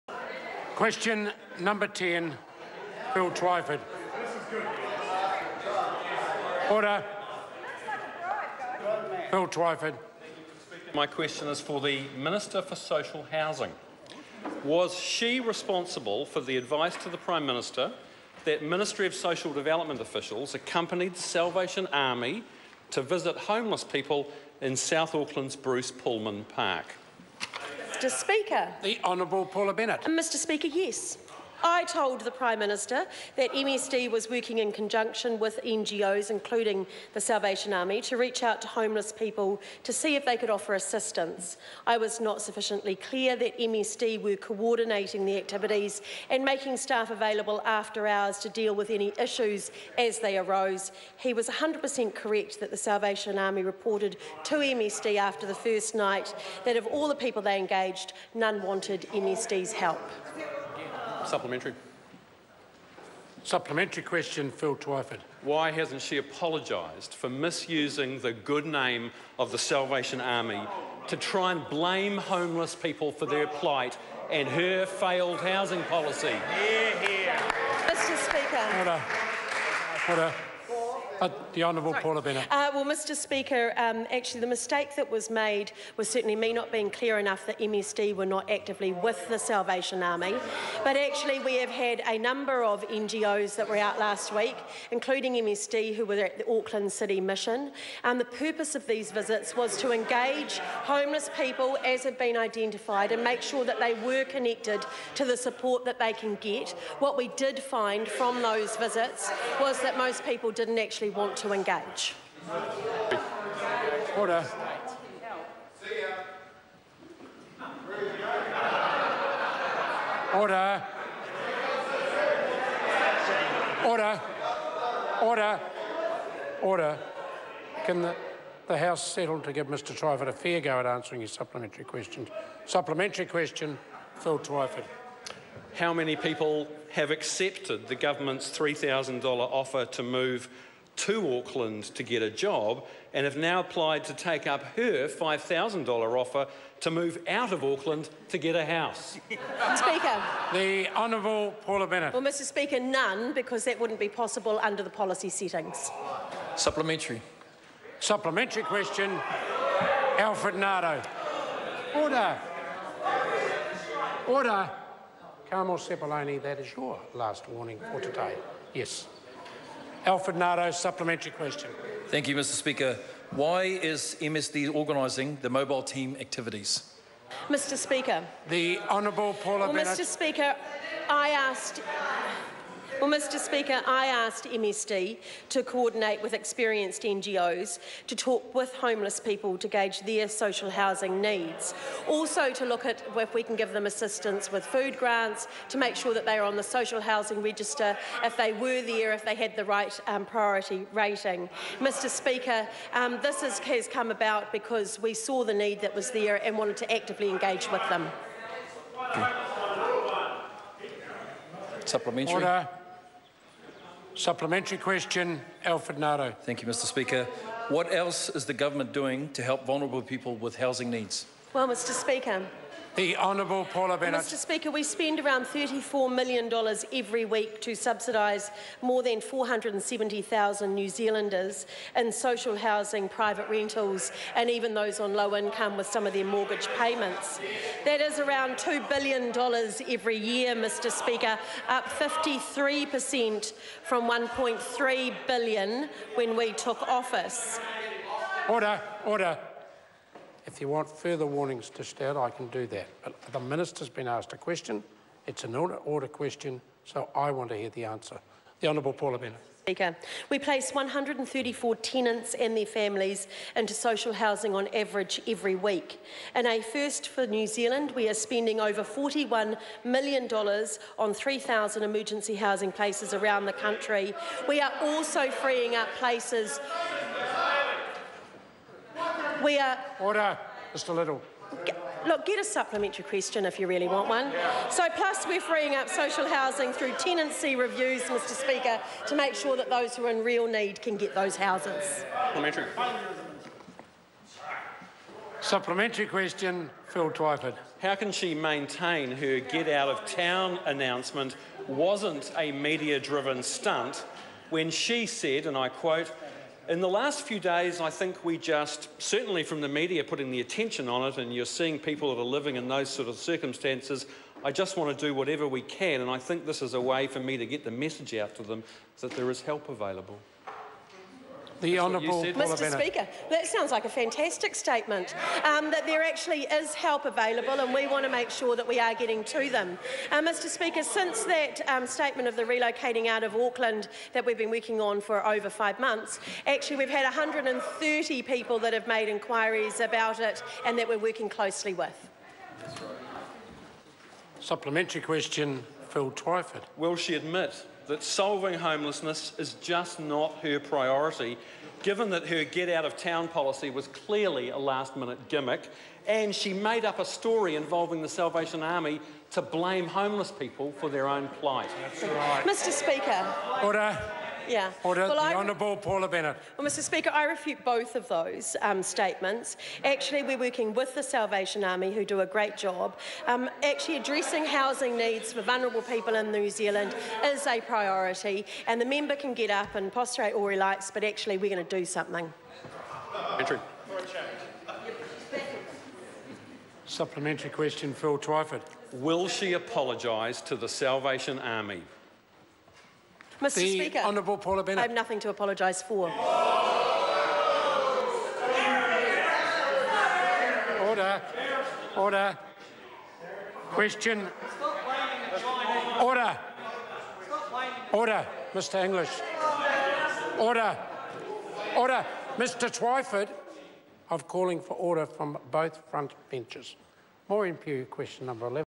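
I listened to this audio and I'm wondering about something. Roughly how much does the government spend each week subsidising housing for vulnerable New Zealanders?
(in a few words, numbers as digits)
$34 million.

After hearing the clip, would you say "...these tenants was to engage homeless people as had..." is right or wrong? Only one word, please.
wrong.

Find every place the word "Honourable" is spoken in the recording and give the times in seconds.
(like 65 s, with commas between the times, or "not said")
29 s, 81 s, 150 s, 178 s, 223 s, 258 s, 365 s, 393 s.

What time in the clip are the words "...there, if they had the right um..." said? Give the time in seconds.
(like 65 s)
198 s.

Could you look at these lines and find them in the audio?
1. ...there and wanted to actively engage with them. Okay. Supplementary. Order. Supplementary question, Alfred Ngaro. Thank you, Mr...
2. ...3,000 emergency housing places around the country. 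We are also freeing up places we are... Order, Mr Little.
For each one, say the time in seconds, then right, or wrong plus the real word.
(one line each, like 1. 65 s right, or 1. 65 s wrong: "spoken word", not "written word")
1. 206 s right
2. 271 s right.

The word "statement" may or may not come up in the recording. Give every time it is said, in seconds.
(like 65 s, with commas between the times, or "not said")
324 s, 331 s, 368 s.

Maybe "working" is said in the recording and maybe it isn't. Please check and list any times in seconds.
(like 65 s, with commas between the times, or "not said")
34 s, 334 s, 340 s, 370 s.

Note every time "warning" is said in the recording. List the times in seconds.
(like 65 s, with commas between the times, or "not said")
167 s, 251 s.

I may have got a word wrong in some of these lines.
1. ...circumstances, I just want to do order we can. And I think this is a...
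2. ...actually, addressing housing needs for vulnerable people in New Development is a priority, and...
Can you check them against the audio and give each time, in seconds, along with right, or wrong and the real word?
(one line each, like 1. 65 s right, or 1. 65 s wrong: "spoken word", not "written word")
1. 313 s wrong: "whatever", not "order"
2. 373 s wrong: "Zealand", not "Development".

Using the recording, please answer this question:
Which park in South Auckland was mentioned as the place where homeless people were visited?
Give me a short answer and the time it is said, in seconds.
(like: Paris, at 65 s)
Bruce Pulman Park, at 25 s.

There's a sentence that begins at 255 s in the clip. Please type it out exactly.
It's an order, order question, so I want to hear the answer.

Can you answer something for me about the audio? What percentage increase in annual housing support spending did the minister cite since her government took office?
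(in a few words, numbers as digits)
53%.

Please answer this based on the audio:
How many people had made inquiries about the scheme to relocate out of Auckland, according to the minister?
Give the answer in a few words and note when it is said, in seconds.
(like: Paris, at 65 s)
130, at 337 s.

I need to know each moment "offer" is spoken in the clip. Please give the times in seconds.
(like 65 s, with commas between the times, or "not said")
40 s, 139 s, 145 s.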